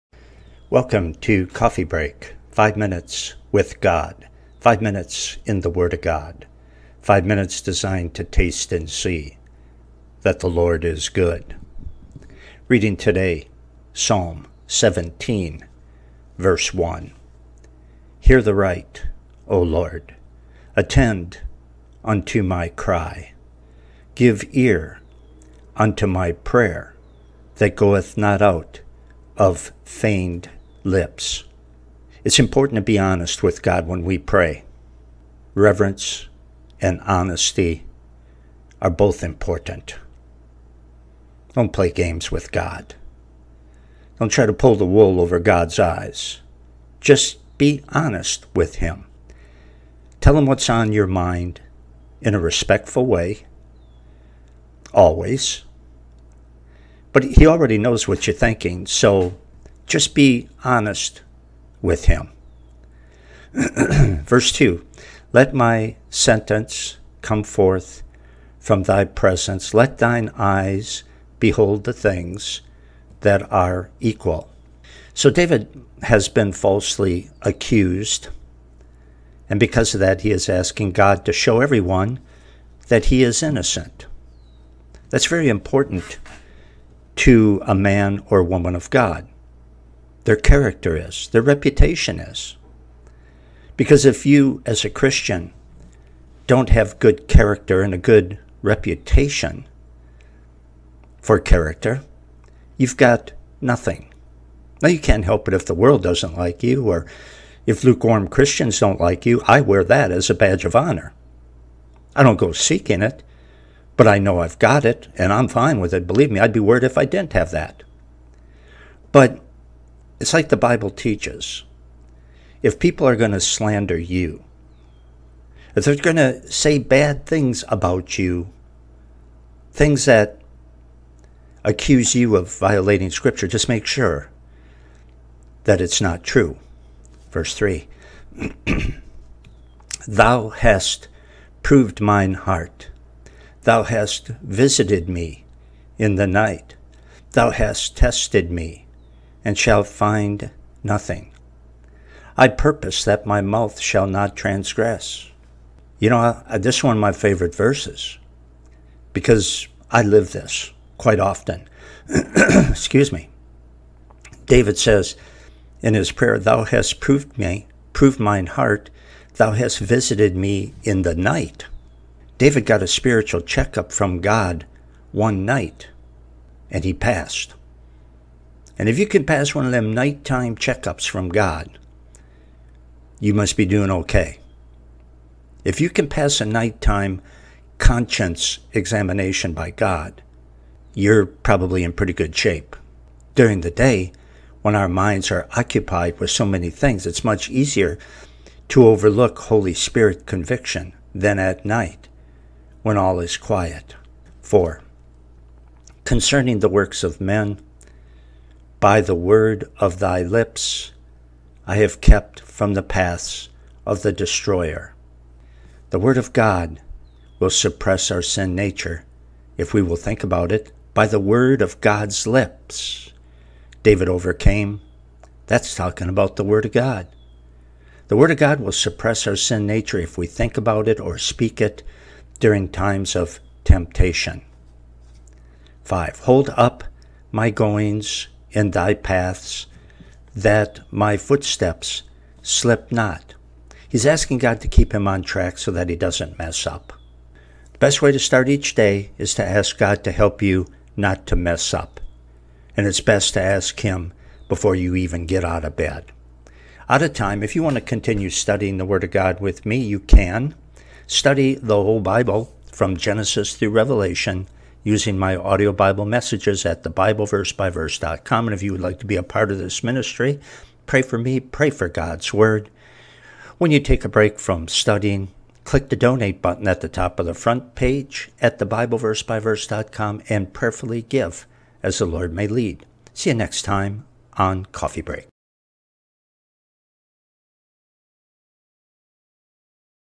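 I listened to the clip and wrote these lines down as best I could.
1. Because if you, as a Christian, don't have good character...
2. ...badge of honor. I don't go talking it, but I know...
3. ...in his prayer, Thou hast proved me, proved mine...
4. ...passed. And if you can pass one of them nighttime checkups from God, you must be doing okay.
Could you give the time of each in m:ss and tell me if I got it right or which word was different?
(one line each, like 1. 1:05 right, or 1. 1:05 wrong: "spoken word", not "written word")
1. 1:33 right
2. 1:50 wrong: "seeking", not "talking"
3. 2:45 right
4. 2:56 right.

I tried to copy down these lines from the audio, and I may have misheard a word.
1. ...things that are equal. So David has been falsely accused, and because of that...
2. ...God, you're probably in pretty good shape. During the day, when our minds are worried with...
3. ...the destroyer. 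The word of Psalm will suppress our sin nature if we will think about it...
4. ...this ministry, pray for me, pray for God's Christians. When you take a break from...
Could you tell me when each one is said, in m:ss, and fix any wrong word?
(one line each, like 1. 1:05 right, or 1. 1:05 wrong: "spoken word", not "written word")
1. 1:11 right
2. 3:09 wrong: "occupied", not "worried"
3. 3:34 wrong: "God", not "Psalm"
4. 4:29 wrong: "Word", not "Christians".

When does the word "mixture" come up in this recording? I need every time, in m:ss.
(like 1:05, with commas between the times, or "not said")
not said.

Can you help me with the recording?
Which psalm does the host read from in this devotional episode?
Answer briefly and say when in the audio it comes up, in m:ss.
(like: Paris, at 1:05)
Psalm 17, at 0:13.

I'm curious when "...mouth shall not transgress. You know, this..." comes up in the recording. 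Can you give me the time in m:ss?
2:33.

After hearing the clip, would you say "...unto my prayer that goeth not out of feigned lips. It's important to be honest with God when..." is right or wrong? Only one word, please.
right.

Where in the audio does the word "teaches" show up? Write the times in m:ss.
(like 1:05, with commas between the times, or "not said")
2:00.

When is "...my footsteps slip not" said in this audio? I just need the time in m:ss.
4:00.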